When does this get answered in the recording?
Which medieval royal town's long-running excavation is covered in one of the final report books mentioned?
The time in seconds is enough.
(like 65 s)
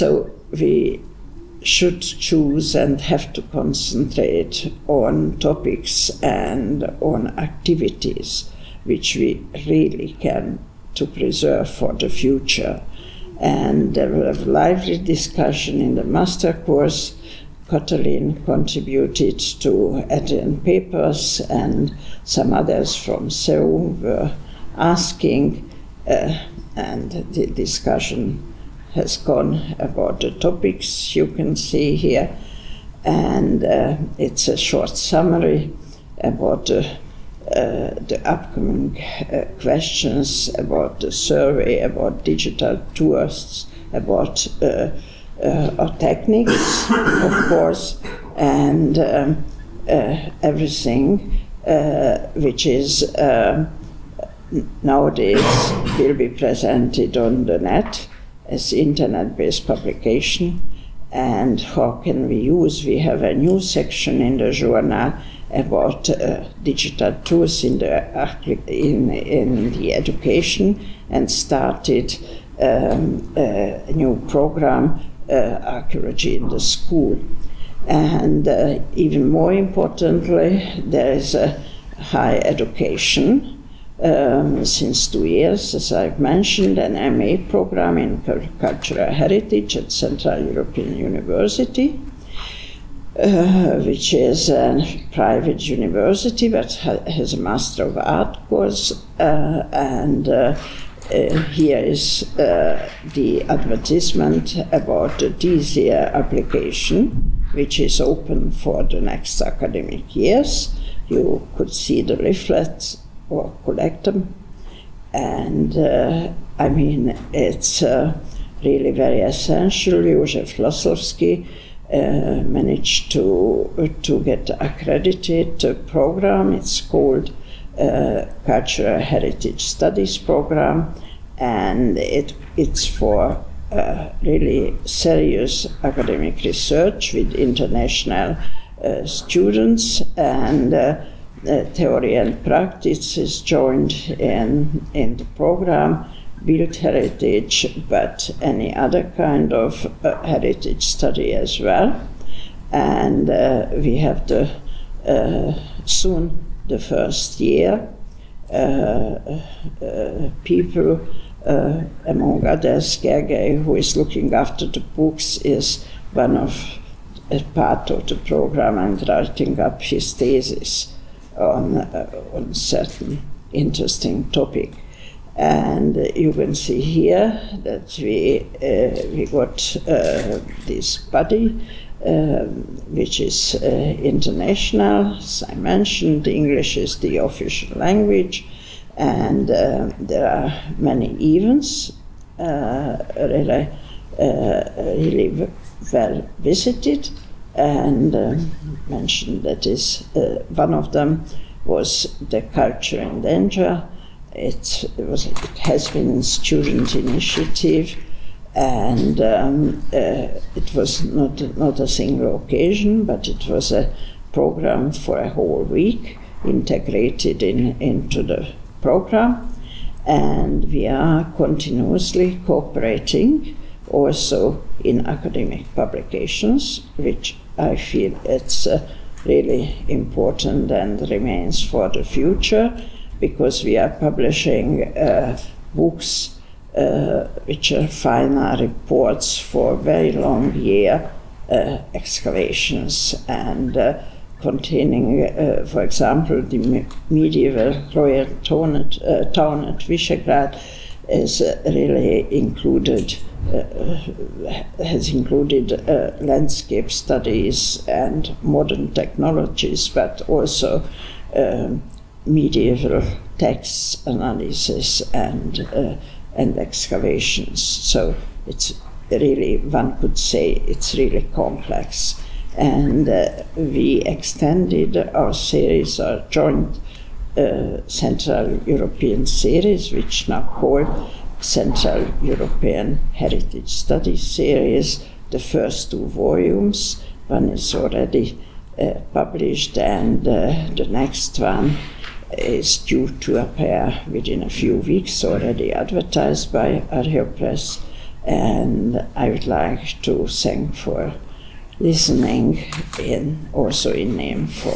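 249 s.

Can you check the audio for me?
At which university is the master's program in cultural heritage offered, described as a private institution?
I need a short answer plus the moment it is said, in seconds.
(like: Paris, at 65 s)
Central European University, at 89 s.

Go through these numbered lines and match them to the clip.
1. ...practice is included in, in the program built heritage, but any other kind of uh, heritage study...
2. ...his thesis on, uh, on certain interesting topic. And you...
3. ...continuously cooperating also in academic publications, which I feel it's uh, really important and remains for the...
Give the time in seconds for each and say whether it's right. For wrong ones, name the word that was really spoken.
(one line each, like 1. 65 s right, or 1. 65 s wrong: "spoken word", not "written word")
1. 142 s wrong: "joined", not "included"
2. 169 s right
3. 221 s right.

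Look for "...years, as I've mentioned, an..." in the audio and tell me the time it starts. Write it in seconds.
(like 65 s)
85 s.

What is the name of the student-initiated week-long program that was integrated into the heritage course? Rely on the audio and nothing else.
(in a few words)
Culture in Danger.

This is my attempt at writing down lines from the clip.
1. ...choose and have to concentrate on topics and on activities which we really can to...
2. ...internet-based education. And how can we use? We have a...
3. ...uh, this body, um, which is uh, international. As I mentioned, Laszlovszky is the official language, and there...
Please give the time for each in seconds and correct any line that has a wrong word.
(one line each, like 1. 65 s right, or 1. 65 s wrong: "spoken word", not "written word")
1. 2 s right
2. 58 s wrong: "publication", not "education"
3. 179 s wrong: "English", not "Laszlovszky".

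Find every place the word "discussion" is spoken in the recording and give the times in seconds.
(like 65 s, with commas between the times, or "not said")
14 s, 27 s.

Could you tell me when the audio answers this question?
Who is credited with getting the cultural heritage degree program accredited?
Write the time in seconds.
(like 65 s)
120 s.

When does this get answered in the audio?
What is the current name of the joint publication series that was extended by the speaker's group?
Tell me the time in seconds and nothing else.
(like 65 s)
281 s.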